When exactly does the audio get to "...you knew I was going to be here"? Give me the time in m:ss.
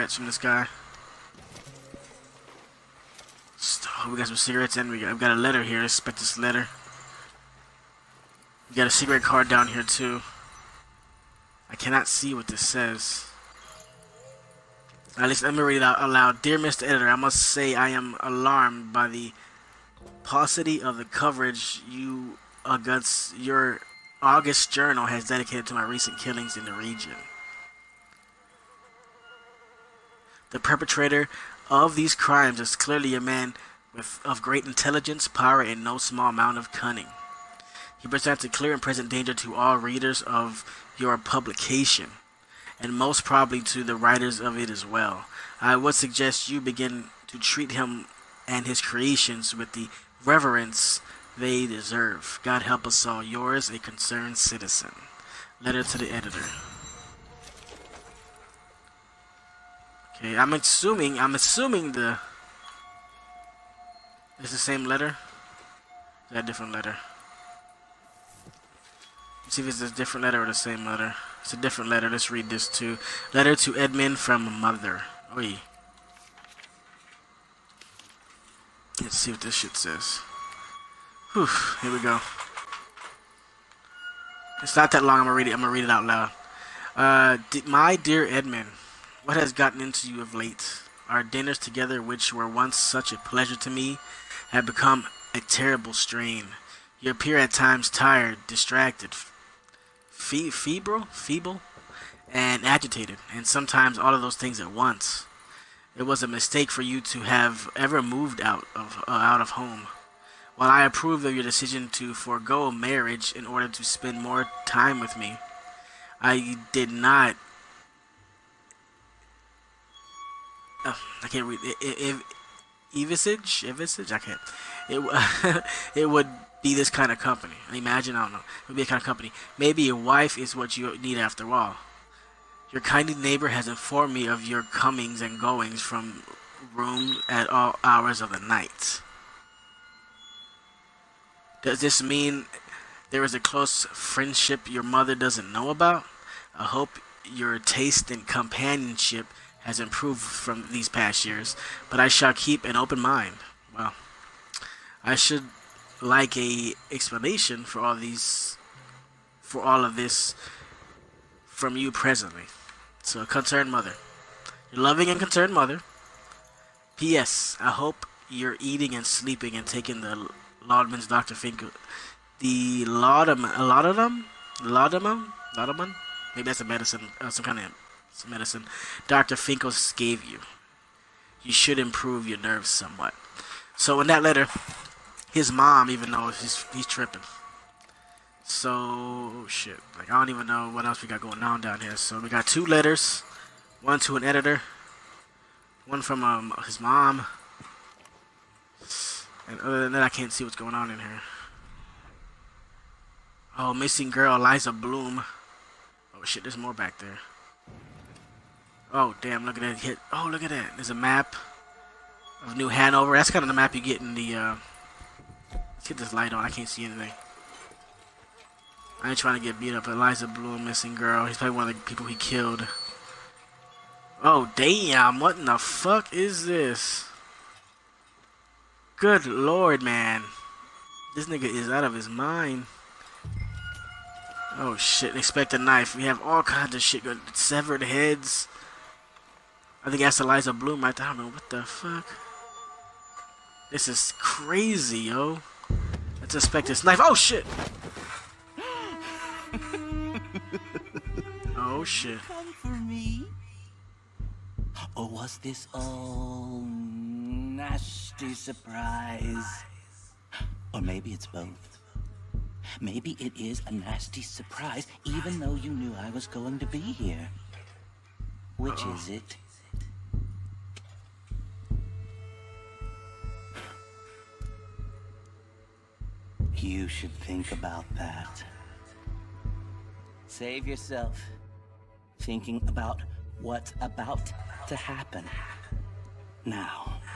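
4:25.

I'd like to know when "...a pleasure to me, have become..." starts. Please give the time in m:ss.
1:33.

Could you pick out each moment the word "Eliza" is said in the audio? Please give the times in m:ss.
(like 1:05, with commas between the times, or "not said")
3:24, 3:39, 4:00.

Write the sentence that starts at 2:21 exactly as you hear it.
Does this mean there is a close friendship your mother doesn't know about?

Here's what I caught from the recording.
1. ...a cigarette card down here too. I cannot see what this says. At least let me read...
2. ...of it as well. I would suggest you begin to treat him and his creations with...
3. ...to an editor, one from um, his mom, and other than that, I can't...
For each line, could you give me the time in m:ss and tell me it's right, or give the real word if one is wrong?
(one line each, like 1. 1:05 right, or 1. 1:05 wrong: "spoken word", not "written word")
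1. 0:08 right
2. 0:44 right
3. 3:13 right.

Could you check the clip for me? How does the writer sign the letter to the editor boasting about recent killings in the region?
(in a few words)
A concerned citizen.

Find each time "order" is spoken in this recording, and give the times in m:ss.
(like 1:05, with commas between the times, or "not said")
1:53.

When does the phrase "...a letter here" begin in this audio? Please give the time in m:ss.
0:05.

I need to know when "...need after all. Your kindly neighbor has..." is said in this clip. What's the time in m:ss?
2:10.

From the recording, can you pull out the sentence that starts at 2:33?
Well, I should like a explanation for all these, for all of this, from you presently.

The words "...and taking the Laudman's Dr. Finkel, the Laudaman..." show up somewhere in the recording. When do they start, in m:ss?
2:49.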